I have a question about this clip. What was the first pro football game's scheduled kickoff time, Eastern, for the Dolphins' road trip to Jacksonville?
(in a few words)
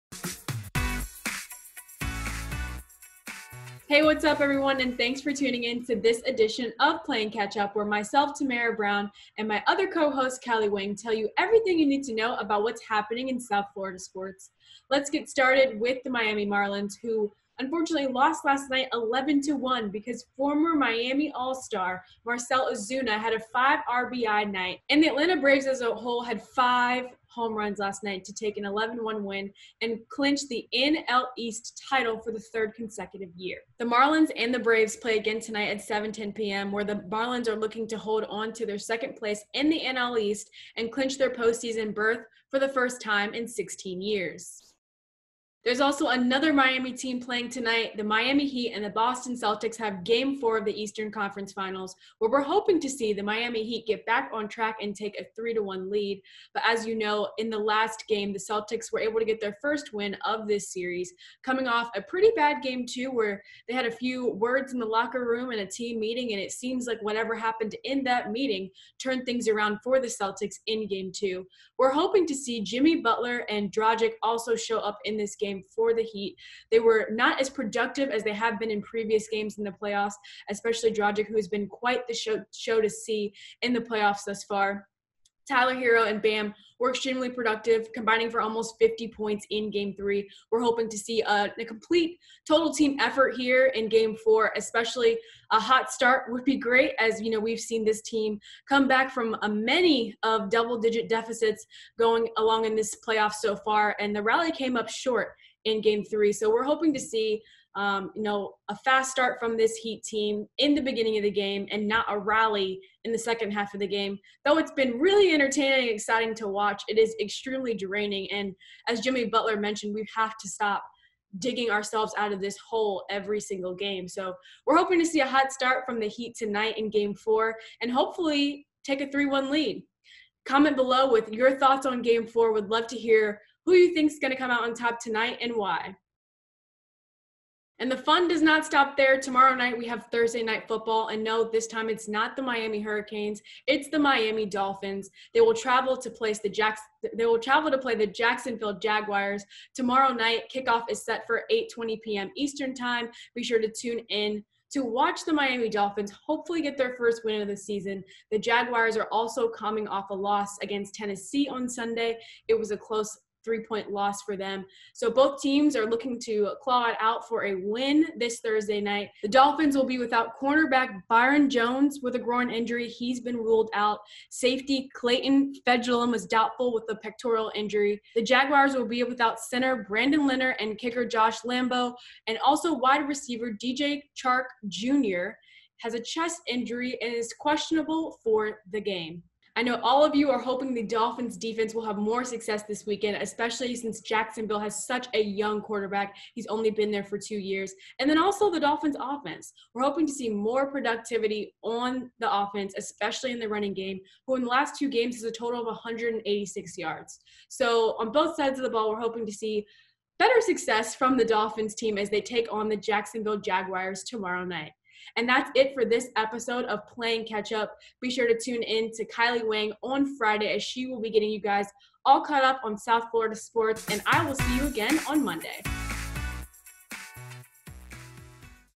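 8:20 p.m.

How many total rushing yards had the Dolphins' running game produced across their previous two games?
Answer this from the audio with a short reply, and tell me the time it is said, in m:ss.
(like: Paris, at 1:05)
186, at 3:25.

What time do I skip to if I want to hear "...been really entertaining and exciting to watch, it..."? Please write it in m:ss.
1:54.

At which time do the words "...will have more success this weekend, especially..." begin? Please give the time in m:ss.
3:11.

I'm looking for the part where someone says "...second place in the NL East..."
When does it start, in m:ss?
0:38.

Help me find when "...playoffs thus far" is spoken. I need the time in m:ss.
1:23.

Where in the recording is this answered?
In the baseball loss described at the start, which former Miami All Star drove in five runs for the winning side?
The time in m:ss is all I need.
0:22.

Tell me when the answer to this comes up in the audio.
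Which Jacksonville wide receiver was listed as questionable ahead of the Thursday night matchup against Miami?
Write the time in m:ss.
3:03.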